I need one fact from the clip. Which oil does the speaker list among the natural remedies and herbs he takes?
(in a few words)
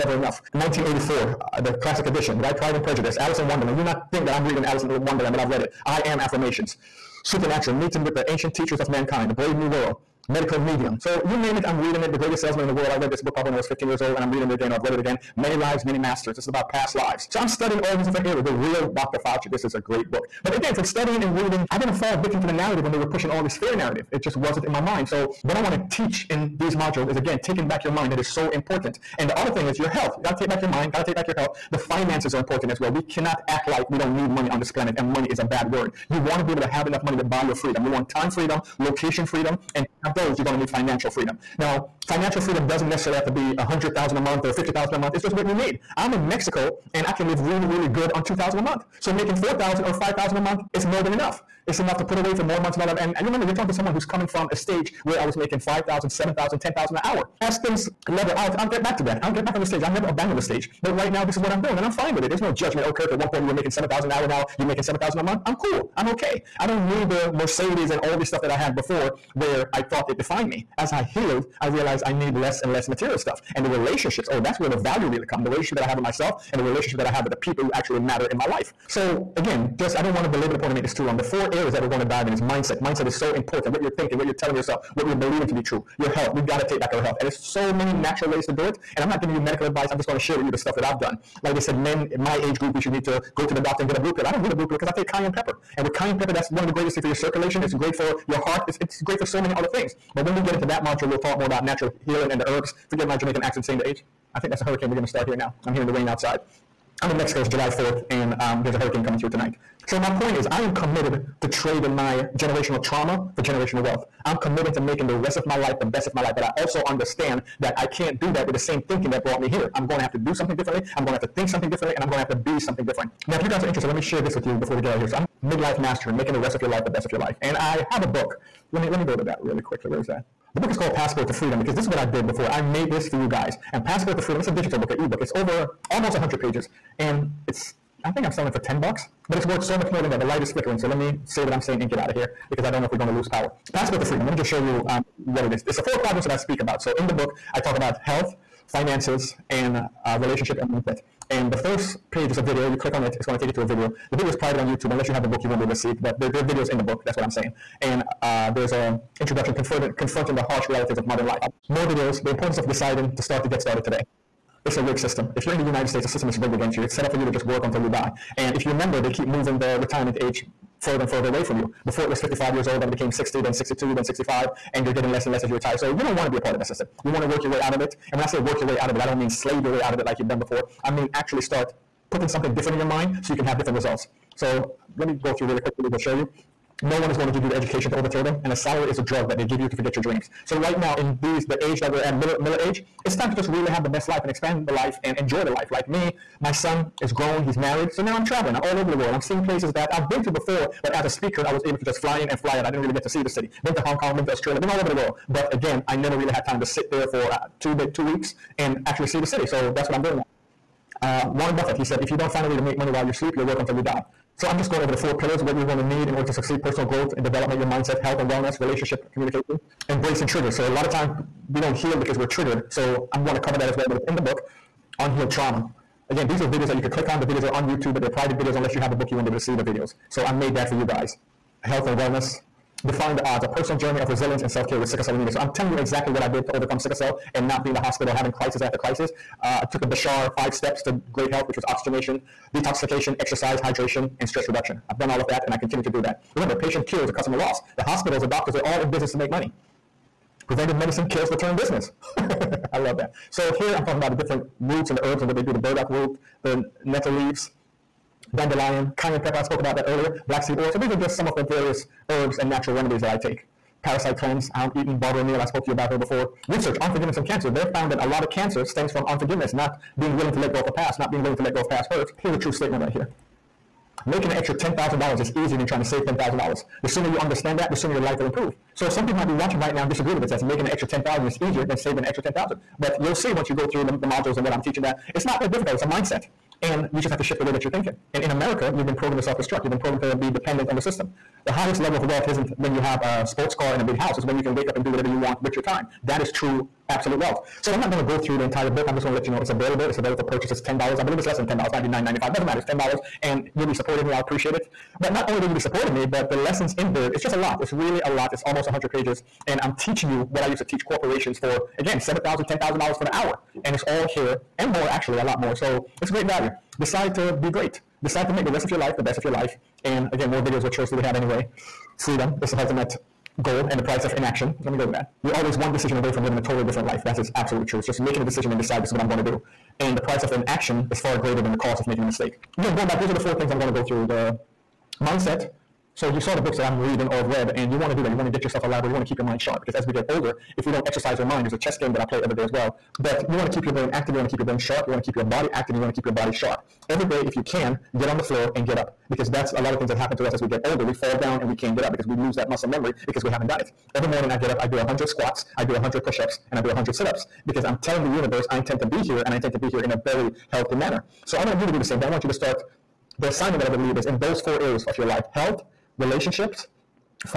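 Black seed oil.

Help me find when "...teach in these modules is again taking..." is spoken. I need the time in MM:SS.
00:25.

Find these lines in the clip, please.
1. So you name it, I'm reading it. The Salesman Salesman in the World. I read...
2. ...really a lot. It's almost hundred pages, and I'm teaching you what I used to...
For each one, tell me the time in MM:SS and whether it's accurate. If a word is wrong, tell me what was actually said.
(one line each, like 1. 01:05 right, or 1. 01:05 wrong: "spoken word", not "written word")
1. 00:10 wrong: "Greatest", not "Salesman"
2. 05:07 right.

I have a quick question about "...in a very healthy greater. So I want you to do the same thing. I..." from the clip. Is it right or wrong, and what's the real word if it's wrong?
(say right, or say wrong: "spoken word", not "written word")
wrong: "manner", not "greater".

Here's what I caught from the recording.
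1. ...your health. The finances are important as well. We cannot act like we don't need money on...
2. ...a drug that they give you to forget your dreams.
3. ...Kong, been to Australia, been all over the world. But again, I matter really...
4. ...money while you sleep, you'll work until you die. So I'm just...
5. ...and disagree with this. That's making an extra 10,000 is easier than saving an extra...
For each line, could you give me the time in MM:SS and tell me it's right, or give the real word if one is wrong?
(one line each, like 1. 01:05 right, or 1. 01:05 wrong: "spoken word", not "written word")
1. 00:31 right
2. 03:08 right
3. 03:23 wrong: "never", not "matter"
4. 03:32 right
5. 04:39 right.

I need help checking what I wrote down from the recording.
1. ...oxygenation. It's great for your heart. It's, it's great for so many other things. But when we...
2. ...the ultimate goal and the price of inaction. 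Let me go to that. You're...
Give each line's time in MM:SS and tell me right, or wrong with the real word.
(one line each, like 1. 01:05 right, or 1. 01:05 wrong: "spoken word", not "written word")
1. 01:37 wrong: "circulation", not "oxygenation"
2. 05:22 right.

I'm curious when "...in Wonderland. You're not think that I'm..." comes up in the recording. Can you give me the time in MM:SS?
00:03.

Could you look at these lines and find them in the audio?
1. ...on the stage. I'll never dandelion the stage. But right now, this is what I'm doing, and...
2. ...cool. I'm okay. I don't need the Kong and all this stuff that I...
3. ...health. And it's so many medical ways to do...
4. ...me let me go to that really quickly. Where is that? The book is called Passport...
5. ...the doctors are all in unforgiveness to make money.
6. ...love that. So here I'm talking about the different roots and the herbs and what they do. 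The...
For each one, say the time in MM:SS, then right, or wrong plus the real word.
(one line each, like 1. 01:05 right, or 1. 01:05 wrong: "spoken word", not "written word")
1. 00:59 wrong: "abandon", not "dandelion"
2. 01:05 wrong: "Mercedes", not "Kong"
3. 01:27 wrong: "natural", not "medical"
4. 02:08 right
5. 04:08 wrong: "business", not "unforgiveness"
6. 04:12 right.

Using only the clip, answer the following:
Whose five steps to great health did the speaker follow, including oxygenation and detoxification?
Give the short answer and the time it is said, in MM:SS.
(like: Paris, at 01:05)
Bashar, at 03:59.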